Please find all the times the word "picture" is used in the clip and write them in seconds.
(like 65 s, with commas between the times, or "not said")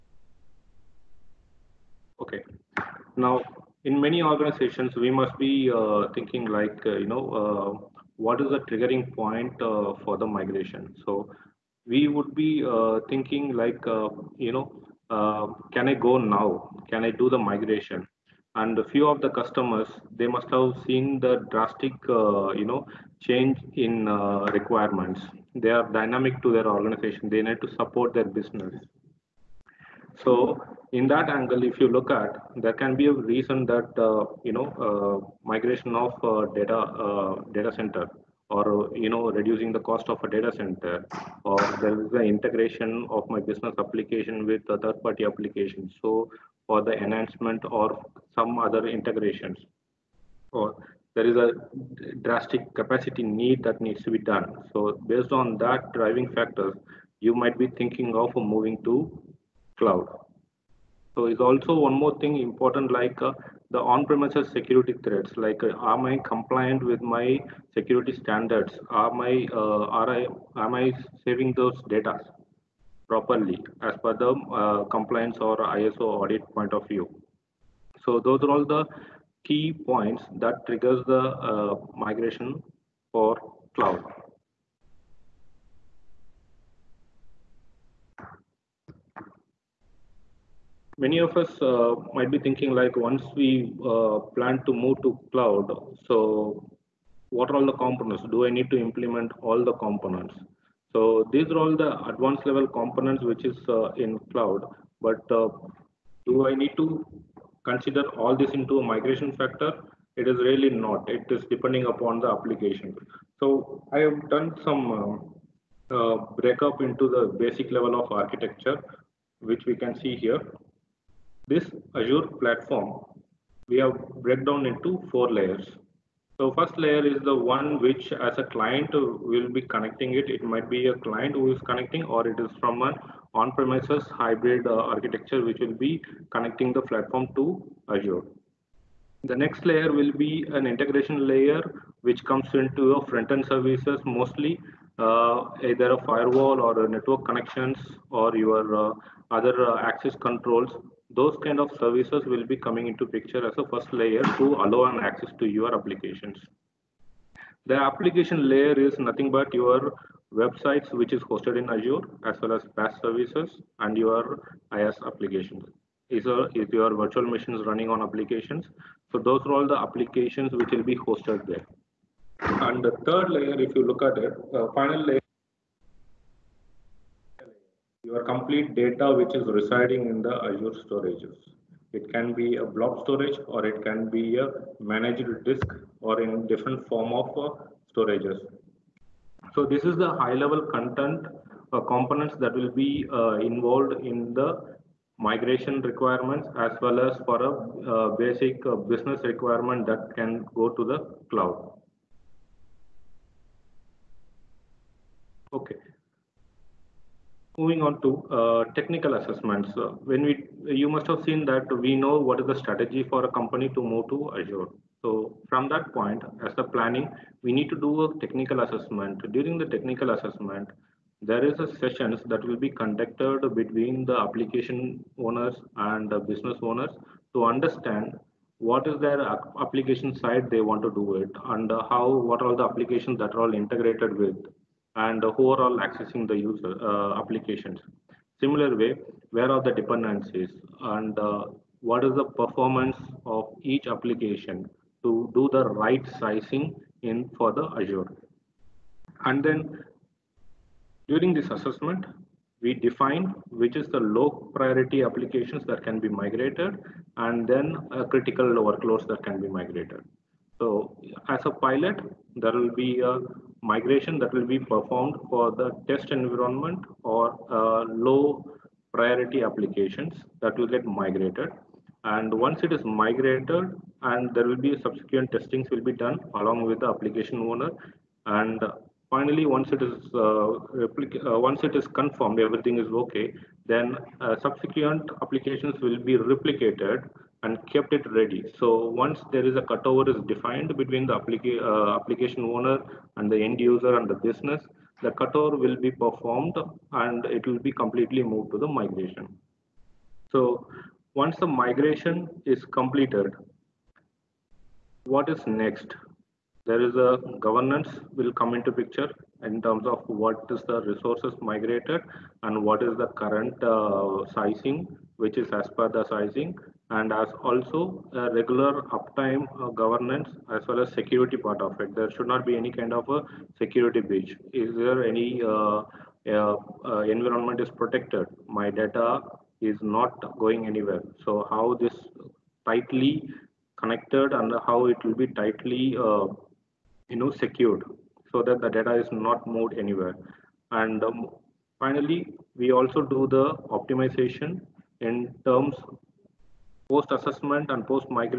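153 s, 308 s.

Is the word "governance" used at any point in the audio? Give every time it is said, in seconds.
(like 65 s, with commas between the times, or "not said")
307 s, 319 s.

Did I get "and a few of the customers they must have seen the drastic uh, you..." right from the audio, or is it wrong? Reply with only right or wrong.
right.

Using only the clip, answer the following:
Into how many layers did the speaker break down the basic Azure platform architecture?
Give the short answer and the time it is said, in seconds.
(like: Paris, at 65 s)
4, at 125 s.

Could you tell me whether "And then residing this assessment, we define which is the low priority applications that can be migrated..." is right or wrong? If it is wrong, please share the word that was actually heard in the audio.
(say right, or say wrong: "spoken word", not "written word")
wrong: "during", not "residing".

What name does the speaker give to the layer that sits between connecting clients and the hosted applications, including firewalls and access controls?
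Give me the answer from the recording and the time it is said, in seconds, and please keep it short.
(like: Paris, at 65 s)
integration layer, at 140 s.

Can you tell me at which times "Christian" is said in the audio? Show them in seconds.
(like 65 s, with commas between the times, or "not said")
not said.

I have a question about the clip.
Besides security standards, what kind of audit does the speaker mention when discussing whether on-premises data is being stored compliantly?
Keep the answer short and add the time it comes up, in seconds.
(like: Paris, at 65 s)
ISO audit, at 75 s.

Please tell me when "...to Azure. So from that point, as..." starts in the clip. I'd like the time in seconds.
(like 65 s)
214 s.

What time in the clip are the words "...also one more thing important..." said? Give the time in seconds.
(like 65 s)
61 s.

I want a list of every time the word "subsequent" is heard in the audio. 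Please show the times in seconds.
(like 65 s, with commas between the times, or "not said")
274 s, 284 s.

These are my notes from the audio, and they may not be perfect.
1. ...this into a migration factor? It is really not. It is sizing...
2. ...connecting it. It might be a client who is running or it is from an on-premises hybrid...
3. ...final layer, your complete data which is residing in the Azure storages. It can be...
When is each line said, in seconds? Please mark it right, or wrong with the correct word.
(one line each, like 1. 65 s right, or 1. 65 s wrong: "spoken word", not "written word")
1. 108 s wrong: "depending", not "sizing"
2. 129 s wrong: "connecting", not "running"
3. 174 s right.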